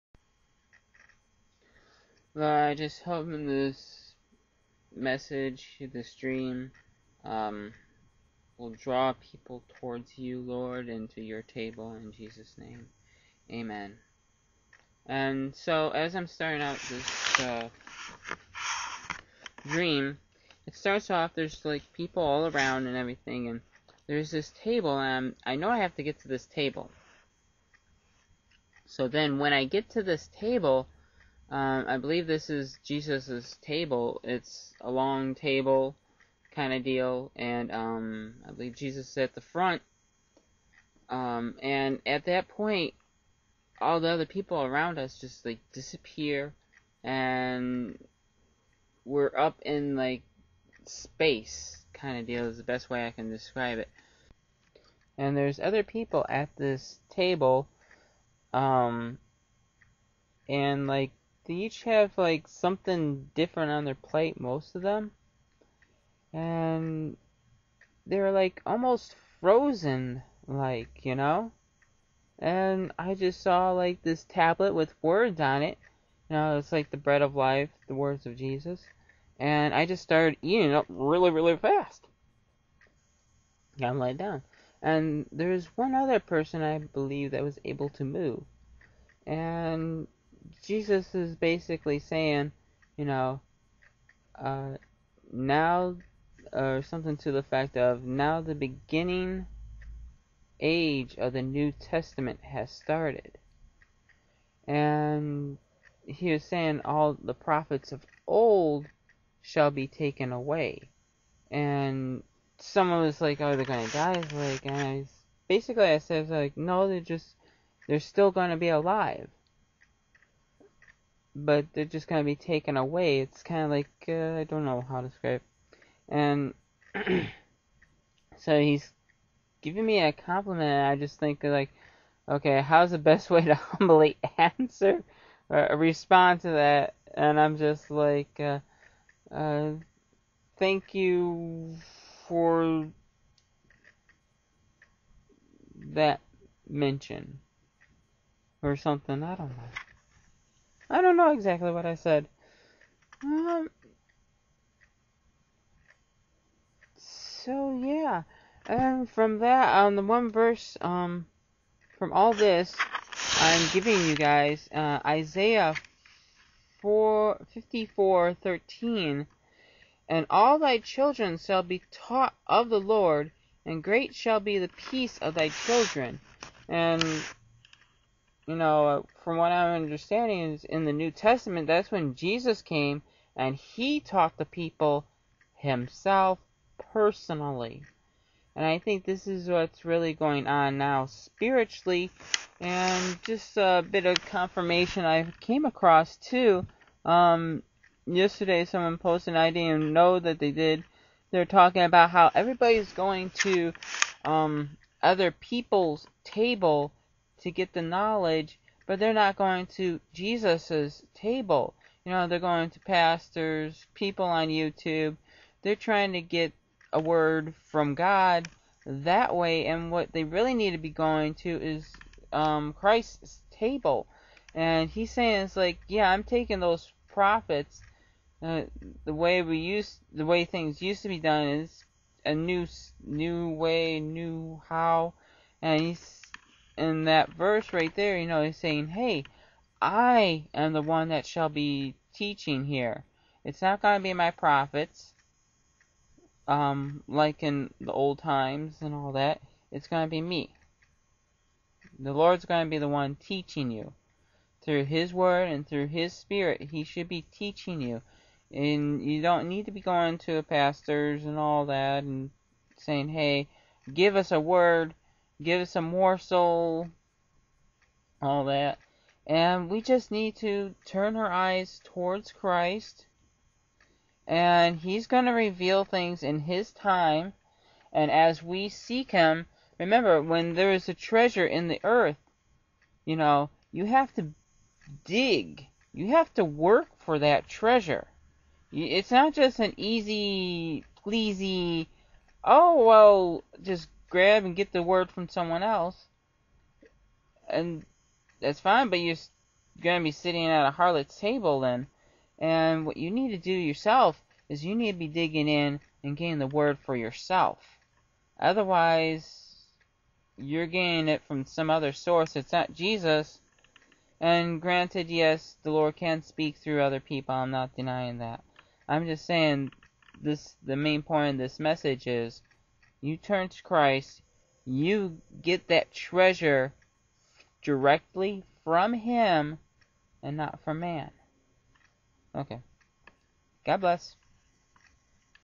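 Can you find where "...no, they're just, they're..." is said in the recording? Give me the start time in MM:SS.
01:56.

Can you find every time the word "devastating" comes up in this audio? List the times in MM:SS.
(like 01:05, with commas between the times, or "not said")
not said.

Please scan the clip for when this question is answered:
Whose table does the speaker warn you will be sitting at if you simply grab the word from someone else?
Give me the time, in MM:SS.
05:00.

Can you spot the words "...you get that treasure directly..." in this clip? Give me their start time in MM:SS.
05:24.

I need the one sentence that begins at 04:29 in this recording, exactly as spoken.
And we just need to turn our eyes towards Christ.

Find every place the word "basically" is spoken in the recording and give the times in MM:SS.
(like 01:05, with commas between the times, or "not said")
01:31, 01:55.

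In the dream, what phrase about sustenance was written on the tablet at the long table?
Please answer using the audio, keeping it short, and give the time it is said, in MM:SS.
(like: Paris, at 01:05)
The bread of life, at 01:16.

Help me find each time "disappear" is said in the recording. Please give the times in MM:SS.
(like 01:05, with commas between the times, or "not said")
00:45.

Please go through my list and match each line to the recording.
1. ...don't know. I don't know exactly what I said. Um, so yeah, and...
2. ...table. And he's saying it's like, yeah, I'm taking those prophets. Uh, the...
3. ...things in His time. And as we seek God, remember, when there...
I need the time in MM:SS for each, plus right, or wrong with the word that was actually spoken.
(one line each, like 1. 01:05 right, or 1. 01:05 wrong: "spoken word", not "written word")
1. 02:29 right
2. 03:43 right
3. 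04:35 wrong: "Him", not "God".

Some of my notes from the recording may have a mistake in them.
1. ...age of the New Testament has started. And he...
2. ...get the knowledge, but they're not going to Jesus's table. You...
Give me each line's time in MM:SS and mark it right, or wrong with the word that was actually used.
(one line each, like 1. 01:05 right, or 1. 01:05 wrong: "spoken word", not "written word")
1. 01:40 right
2. 03:27 right.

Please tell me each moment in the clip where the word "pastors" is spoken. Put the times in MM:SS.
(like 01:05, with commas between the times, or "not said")
03:32, 04:20.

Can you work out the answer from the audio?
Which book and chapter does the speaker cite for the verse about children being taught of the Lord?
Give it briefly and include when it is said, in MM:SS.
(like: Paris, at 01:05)
Isaiah 4, at 02:45.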